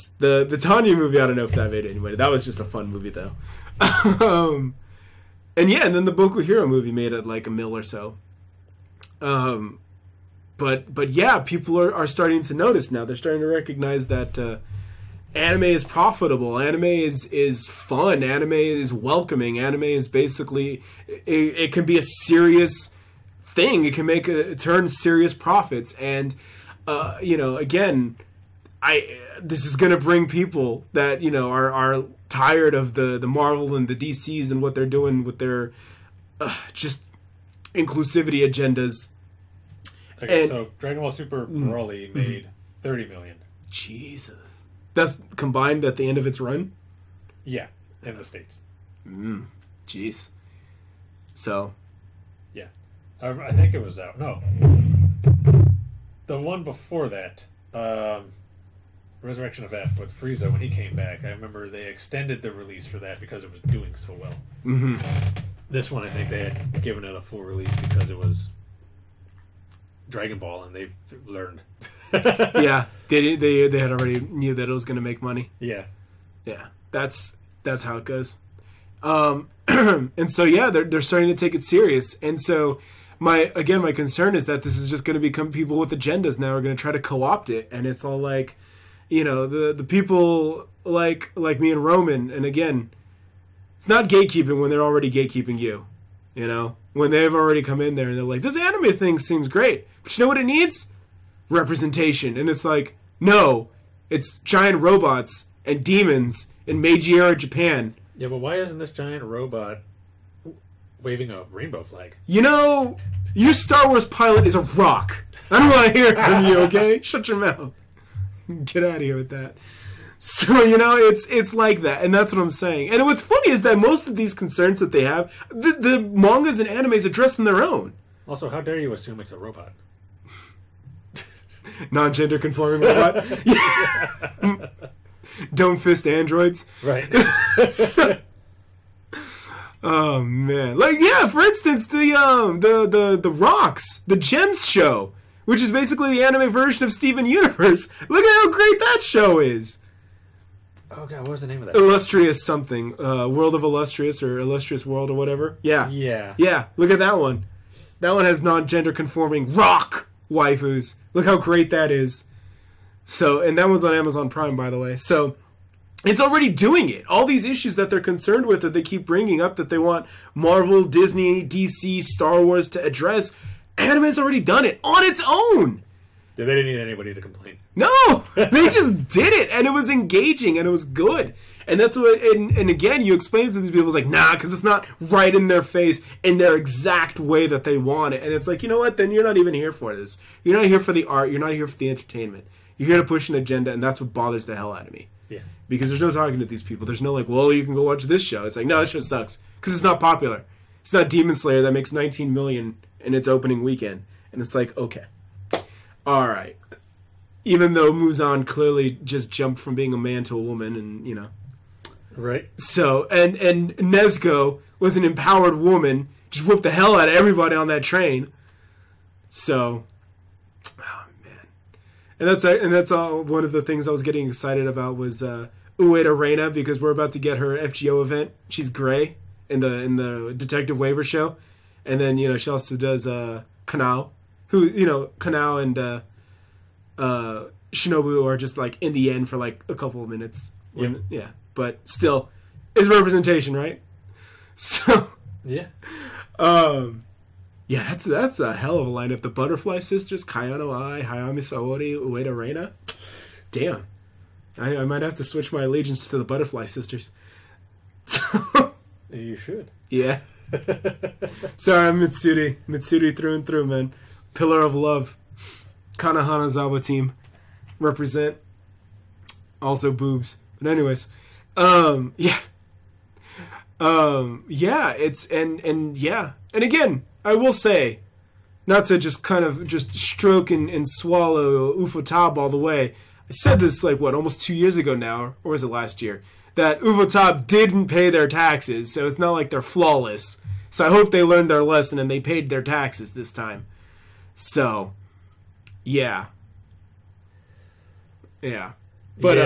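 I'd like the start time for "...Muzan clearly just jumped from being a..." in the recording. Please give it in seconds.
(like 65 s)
207 s.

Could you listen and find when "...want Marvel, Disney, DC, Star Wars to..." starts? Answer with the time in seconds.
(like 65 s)
169 s.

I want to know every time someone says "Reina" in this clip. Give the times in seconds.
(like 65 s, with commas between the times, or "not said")
226 s, 252 s.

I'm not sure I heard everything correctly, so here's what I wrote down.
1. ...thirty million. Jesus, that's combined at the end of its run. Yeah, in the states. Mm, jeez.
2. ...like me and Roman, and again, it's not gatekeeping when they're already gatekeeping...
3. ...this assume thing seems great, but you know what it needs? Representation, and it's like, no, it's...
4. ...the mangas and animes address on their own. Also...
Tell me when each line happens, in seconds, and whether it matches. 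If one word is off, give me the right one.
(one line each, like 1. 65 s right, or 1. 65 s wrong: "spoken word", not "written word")
1. 42 s right
2. 91 s right
3. 98 s wrong: "anime", not "assume"
4. 125 s right.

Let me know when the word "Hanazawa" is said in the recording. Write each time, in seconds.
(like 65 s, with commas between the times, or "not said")
266 s.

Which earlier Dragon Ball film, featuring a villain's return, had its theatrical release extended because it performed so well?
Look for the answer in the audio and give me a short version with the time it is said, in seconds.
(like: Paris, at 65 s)
Resurrection of F, at 59 s.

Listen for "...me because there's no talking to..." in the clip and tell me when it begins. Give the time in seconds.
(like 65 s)
194 s.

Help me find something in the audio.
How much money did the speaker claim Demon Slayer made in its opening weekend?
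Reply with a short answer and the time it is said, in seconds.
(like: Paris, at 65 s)
19 million, at 201 s.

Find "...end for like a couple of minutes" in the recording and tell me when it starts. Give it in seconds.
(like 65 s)
239 s.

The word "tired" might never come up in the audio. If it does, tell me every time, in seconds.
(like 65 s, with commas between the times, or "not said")
32 s.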